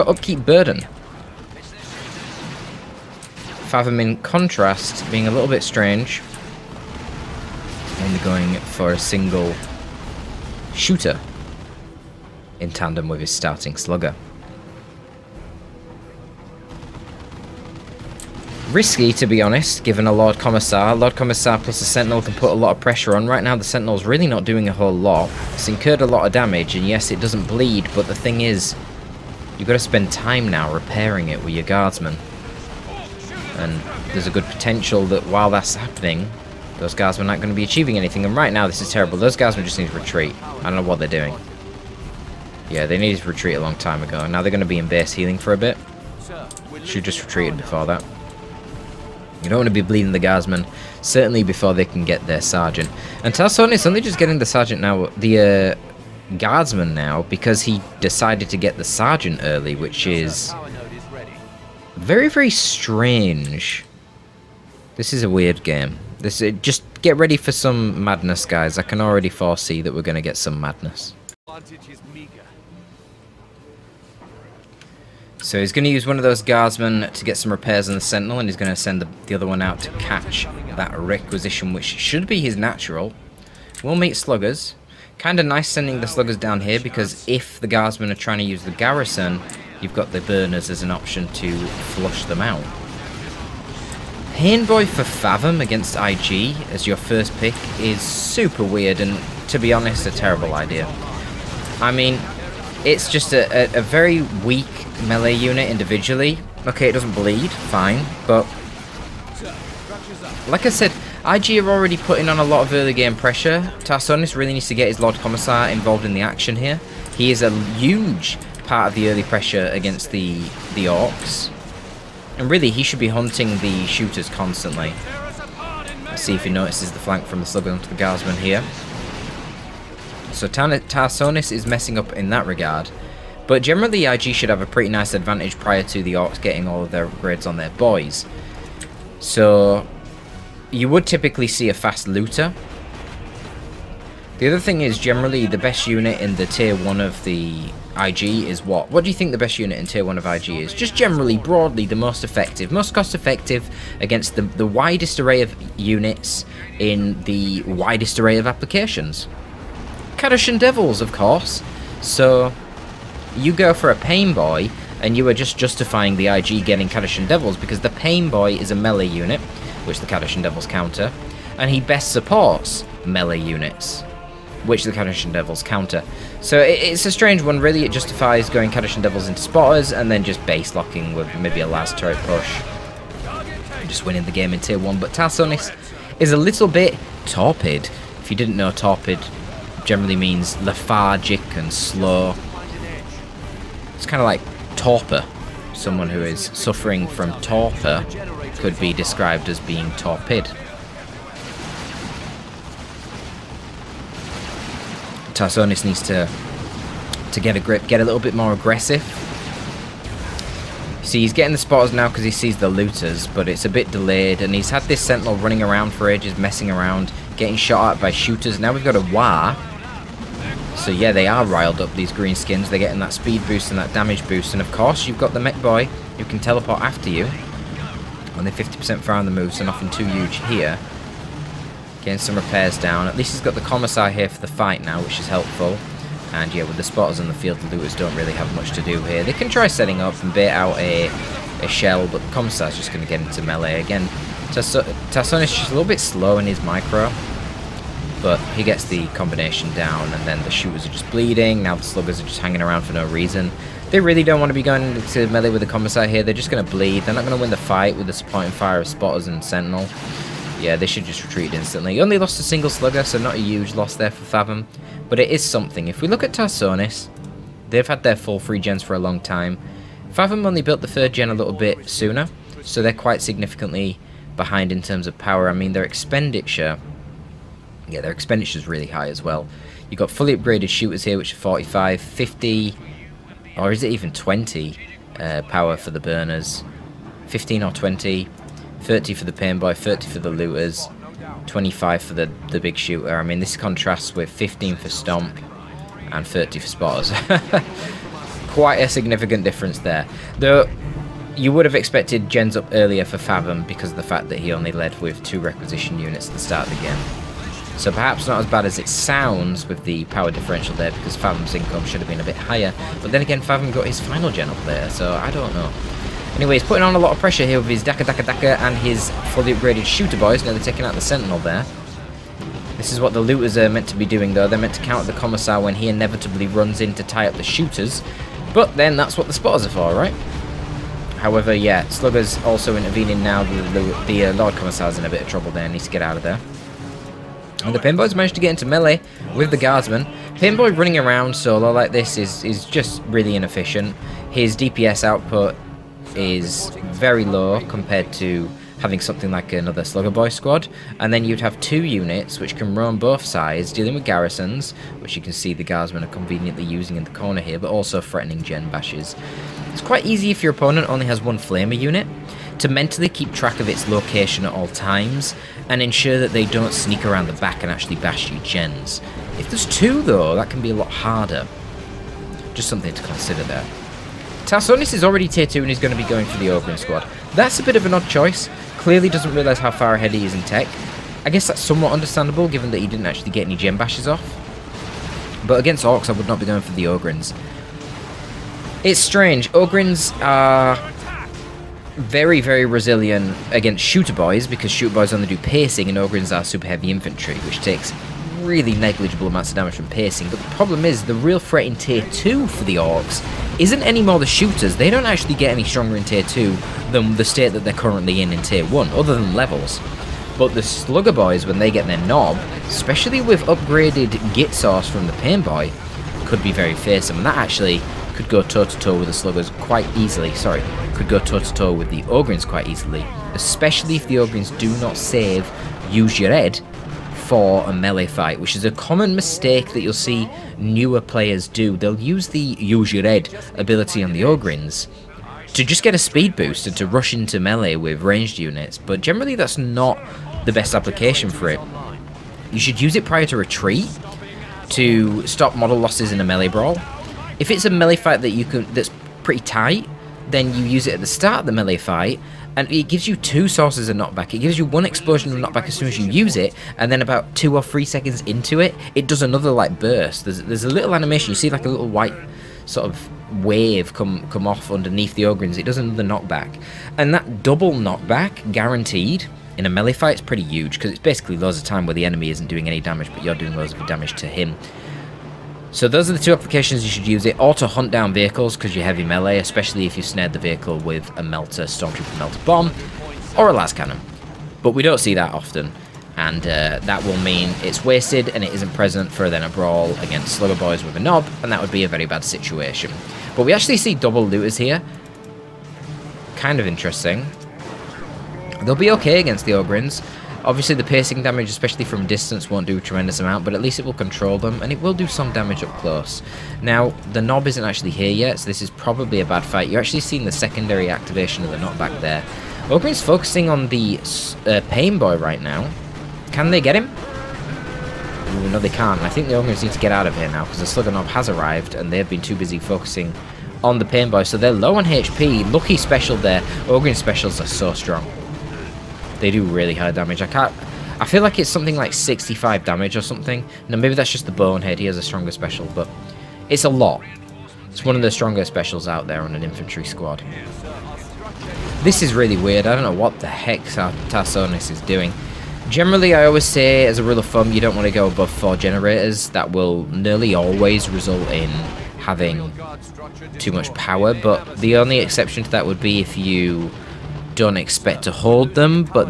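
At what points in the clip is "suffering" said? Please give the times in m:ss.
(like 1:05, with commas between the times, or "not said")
3:16.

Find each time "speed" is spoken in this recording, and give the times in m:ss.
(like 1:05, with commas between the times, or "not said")
3:43, 7:15.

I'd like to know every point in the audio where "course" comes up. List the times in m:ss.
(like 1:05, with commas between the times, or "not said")
2:41, 3:44.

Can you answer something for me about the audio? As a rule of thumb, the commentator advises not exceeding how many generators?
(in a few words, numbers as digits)
Four.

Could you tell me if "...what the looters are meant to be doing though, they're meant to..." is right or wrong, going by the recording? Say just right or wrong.
right.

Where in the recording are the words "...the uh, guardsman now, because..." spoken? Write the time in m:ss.
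0:55.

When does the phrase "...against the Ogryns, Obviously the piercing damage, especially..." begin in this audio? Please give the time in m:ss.
8:19.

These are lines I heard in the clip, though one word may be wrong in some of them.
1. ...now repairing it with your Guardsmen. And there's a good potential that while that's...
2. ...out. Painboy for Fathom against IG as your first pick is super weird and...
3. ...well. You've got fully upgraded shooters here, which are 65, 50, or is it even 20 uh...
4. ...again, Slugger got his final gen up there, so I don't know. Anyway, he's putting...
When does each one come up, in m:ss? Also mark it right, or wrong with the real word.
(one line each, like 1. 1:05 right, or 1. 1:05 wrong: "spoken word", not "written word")
1. 0:30 right
2. 1:32 right
3. 4:39 wrong: "45", not "65"
4. 5:13 wrong: "Fathom", not "Slugger".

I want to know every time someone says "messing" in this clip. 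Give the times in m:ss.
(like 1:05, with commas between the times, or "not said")
2:11, 3:36.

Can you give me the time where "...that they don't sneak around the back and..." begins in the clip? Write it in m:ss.
6:06.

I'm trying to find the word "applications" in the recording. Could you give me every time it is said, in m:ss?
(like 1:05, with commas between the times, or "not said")
2:38, 7:20, 7:56.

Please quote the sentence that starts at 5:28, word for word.
But then that's what the spotters are for, right?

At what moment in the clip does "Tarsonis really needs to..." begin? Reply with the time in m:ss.
1:53.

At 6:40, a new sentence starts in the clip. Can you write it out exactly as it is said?
But the problem is the real threat in tier 2 for the orcs isn't any more the shooters.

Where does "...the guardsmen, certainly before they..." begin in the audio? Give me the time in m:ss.
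0:50.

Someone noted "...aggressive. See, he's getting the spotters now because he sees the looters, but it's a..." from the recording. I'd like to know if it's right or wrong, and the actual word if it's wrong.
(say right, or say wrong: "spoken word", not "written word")
right.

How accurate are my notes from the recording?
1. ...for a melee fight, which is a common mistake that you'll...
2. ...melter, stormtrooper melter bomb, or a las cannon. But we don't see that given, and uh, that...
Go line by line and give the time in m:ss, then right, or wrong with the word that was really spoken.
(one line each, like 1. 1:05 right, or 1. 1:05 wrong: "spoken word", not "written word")
1. 7:07 right
2. 8:01 wrong: "often", not "given".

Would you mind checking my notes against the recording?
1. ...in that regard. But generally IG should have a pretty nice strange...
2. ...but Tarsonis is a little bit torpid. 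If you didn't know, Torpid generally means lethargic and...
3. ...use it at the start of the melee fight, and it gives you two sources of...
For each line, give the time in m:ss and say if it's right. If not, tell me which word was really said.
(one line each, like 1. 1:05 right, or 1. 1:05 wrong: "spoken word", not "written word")
1. 2:12 wrong: "advantage", not "strange"
2. 3:04 right
3. 7:30 right.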